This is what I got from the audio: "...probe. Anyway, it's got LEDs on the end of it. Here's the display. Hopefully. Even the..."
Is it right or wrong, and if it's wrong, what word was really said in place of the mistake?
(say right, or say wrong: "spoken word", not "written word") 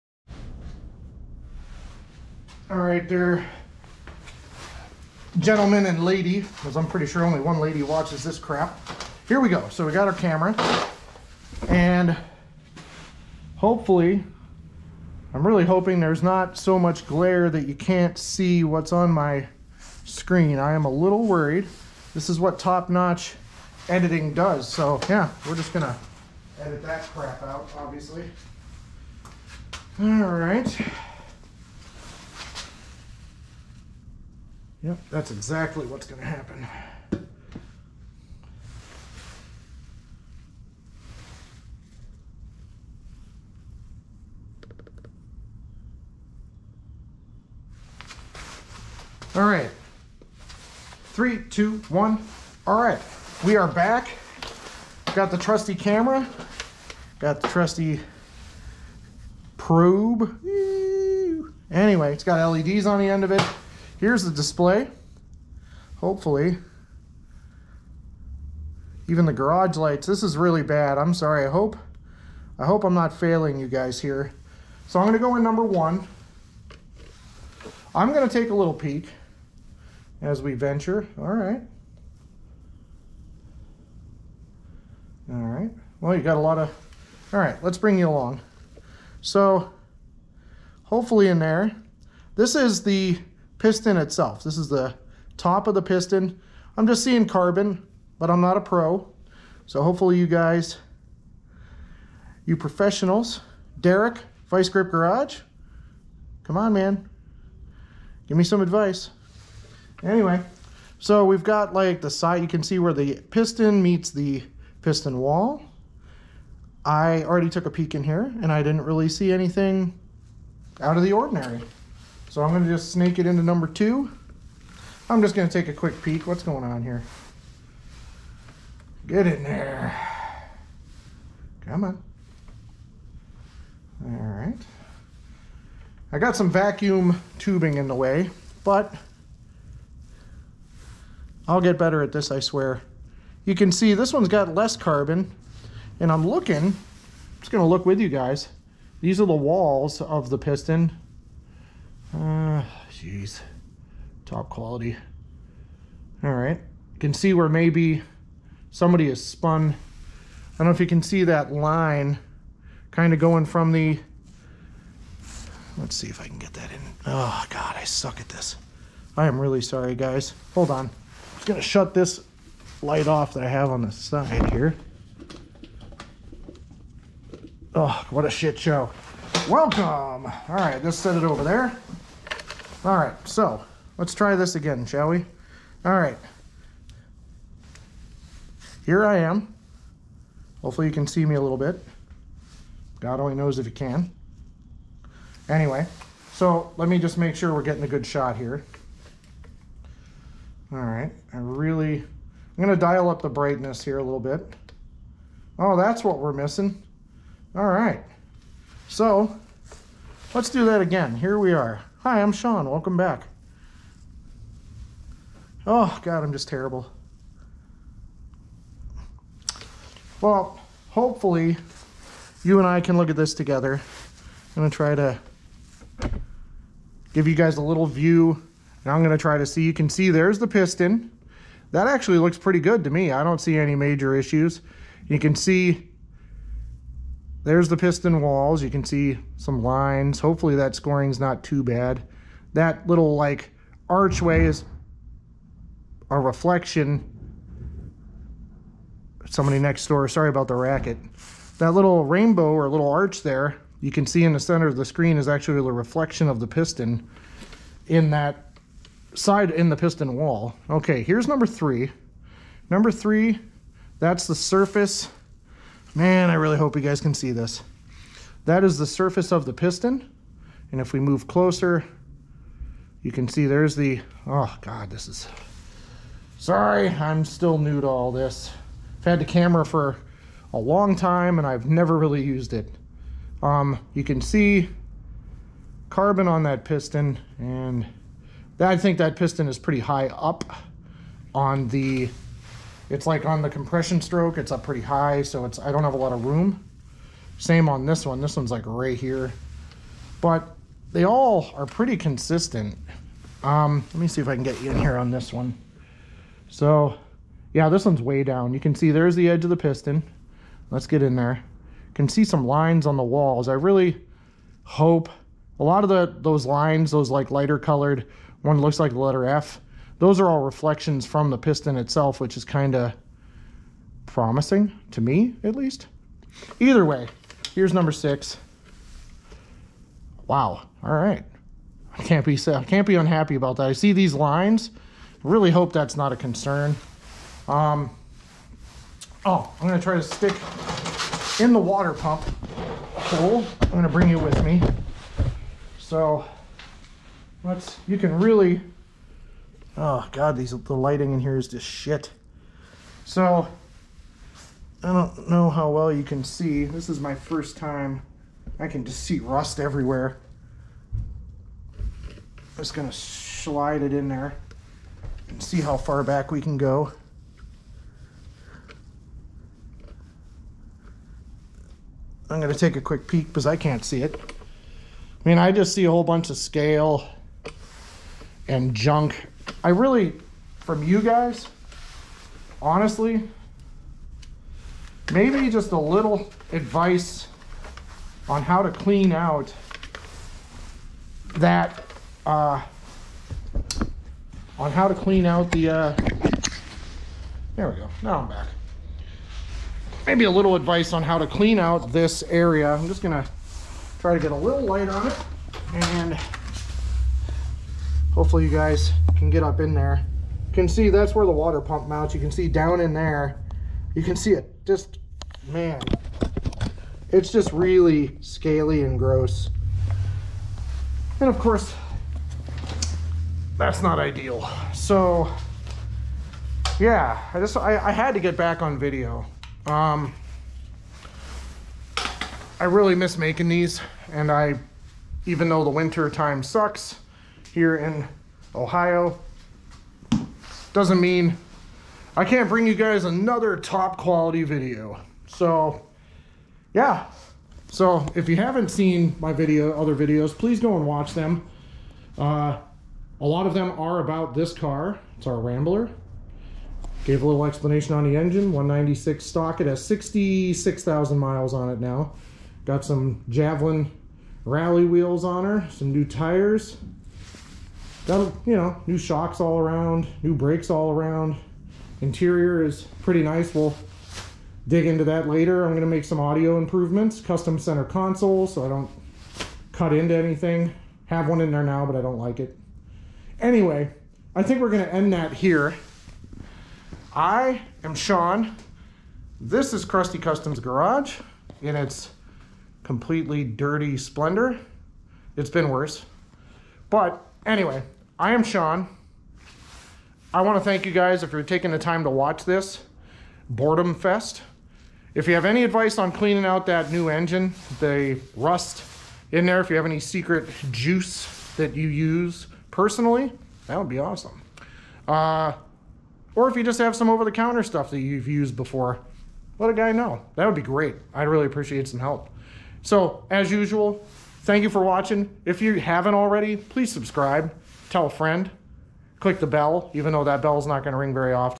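right.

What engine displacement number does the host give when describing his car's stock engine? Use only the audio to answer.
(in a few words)
196.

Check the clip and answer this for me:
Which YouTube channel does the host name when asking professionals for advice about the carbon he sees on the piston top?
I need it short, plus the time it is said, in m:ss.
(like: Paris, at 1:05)
Vice Grip Garage, at 1:44.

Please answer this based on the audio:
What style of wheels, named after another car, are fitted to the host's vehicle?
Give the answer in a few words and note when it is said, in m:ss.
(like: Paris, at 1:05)
Javelin rally wheels, at 7:43.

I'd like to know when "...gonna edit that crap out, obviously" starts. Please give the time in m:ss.
0:25.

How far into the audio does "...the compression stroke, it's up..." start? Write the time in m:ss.
4:53.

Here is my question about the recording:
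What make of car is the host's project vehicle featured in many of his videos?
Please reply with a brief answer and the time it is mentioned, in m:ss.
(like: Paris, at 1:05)
Rambler, at 7:35.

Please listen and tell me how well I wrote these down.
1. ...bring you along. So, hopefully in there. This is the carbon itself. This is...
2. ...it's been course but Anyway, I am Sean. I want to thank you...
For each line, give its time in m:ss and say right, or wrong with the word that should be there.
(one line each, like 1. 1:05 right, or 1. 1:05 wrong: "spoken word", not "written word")
1. 1:27 wrong: "piston", not "carbon"
2. 8:15 wrong: "worse", not "course".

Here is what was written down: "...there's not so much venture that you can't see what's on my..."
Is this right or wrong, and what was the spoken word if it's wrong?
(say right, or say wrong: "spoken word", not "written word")
wrong: "glare", not "venture".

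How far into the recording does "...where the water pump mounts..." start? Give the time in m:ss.
6:51.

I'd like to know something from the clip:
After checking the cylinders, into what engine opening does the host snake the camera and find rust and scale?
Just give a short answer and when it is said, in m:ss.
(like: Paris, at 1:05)
water pump hole, at 5:41.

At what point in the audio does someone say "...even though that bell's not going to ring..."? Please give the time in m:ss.
8:49.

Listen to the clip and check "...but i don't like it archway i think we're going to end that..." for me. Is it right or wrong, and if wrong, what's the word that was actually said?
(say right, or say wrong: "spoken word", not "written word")
wrong: "anyway", not "archway".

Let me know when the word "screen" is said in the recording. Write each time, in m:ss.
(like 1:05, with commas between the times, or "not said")
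0:20, 4:14.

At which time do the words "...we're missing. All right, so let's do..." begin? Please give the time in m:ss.
3:26.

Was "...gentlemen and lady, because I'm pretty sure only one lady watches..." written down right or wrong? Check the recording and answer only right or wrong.
right.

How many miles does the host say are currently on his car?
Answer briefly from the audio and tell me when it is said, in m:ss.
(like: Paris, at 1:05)
66,000, at 7:39.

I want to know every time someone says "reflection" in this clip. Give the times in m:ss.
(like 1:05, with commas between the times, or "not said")
4:06, 4:15, 5:20.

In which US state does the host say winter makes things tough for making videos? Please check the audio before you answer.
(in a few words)
Ohio.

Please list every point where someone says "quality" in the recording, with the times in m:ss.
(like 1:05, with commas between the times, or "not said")
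2:34, 7:23.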